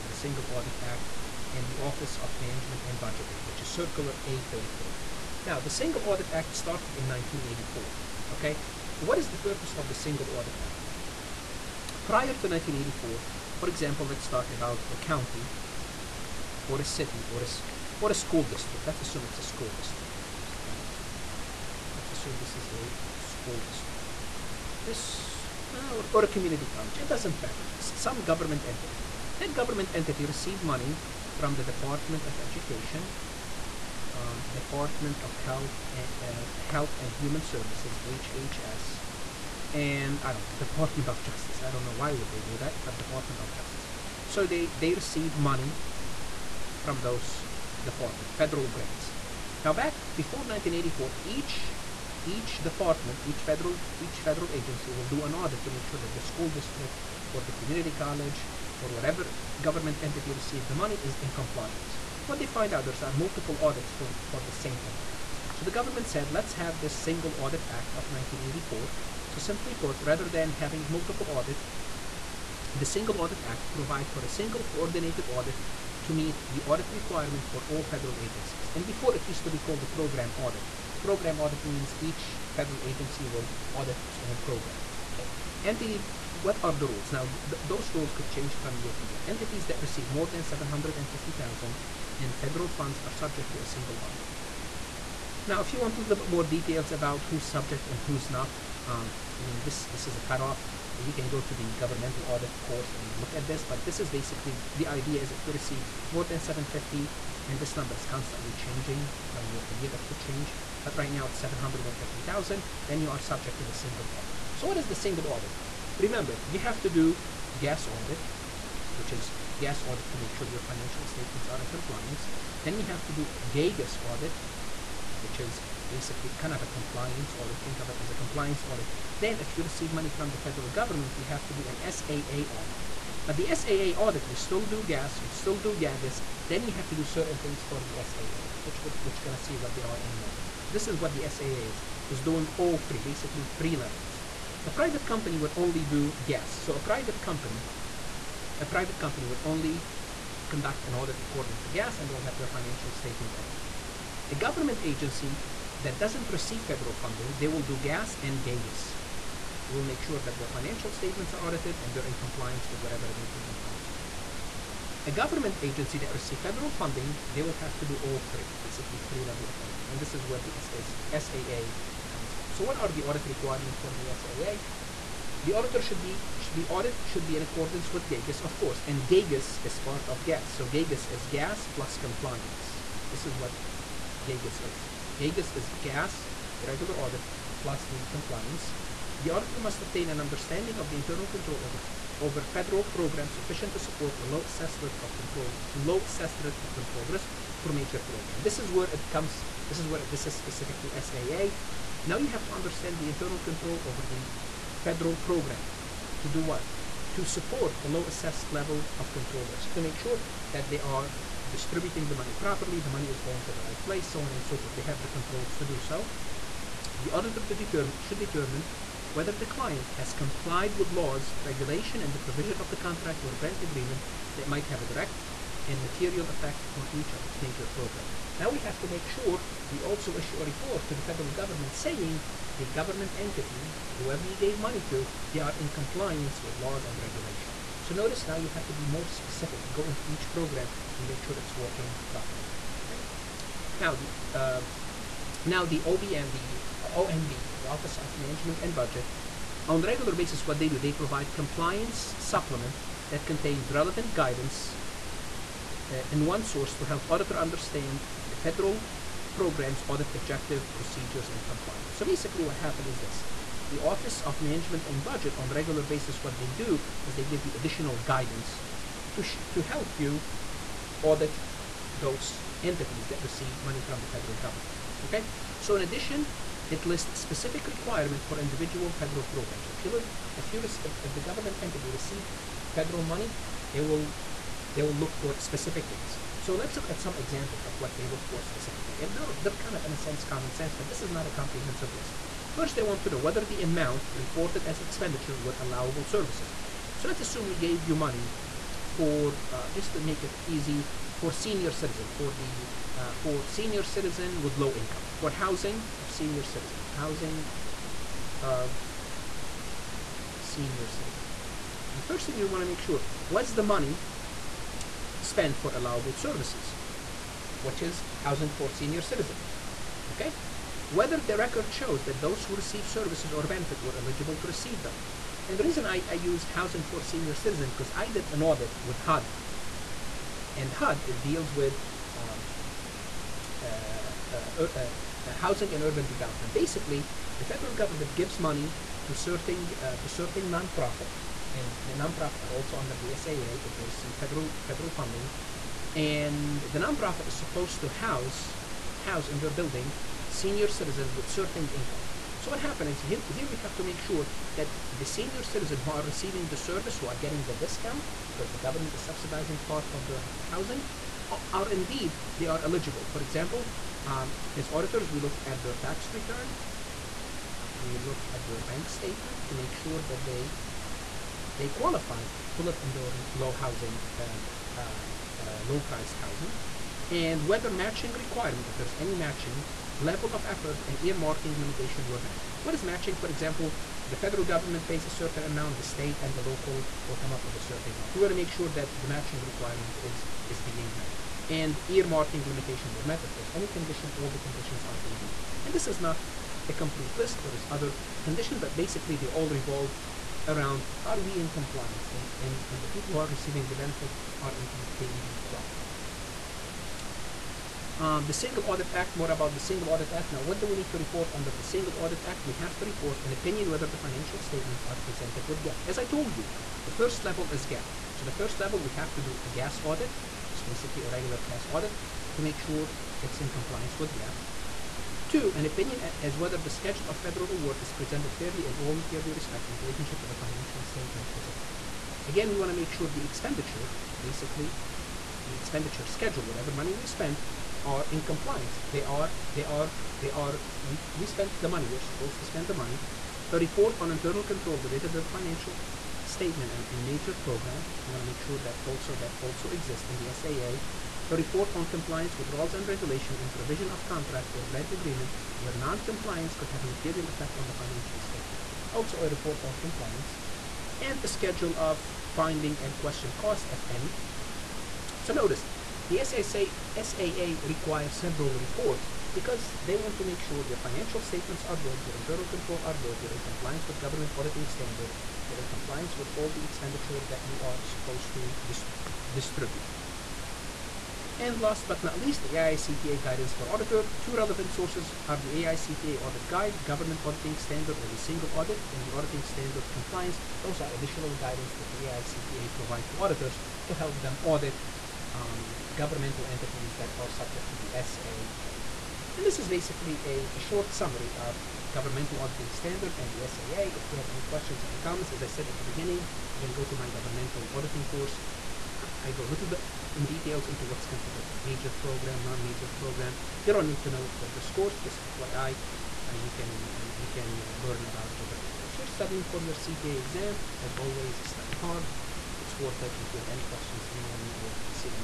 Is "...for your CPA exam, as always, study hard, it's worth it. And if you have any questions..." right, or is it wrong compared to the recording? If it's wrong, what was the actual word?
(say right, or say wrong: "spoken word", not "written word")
right.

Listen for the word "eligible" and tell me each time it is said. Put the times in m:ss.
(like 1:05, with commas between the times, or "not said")
5:23, 6:02.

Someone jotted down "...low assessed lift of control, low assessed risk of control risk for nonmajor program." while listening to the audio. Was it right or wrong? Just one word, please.
wrong.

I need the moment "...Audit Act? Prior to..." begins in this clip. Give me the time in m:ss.
0:10.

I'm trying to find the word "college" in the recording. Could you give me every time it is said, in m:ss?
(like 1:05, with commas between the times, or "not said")
0:26, 0:57.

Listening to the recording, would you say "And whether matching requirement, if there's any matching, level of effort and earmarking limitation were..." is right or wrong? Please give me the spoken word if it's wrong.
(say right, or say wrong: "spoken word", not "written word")
right.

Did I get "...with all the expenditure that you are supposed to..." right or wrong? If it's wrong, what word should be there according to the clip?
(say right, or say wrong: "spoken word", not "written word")
right.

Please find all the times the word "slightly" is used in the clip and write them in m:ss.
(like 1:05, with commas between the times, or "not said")
not said.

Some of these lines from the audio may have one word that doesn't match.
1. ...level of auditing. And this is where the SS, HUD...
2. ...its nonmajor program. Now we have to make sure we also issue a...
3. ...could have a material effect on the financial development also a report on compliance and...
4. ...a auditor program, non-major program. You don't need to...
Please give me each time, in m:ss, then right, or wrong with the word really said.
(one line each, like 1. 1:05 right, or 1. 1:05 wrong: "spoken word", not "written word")
1. 2:49 wrong: "SAA", not "HUD"
2. 3:47 wrong: "major", not "nonmajor"
3. 7:36 wrong: "statement", not "development"
4. 8:31 wrong: "major", not "auditor".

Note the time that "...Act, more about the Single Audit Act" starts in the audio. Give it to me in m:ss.
6:48.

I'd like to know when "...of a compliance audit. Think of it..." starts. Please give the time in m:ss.
2:06.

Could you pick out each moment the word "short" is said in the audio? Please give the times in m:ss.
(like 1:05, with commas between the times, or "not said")
8:20.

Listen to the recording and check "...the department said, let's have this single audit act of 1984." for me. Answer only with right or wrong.
wrong.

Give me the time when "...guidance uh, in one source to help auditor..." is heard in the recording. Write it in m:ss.
4:14.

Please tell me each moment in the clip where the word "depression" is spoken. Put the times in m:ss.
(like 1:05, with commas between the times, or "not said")
not said.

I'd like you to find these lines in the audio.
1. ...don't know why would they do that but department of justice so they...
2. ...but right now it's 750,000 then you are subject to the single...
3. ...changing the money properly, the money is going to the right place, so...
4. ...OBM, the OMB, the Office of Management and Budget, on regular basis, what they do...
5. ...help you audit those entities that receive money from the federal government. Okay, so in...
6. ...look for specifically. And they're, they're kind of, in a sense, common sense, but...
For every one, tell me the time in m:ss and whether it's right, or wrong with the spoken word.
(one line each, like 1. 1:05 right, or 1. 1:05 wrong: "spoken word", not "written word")
1. 0:41 right
2. 1:50 right
3. 3:31 wrong: "distributing", not "changing"
4. 4:05 right
5. 4:29 right
6. 4:48 right.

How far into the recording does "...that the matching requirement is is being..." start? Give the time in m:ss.
6:28.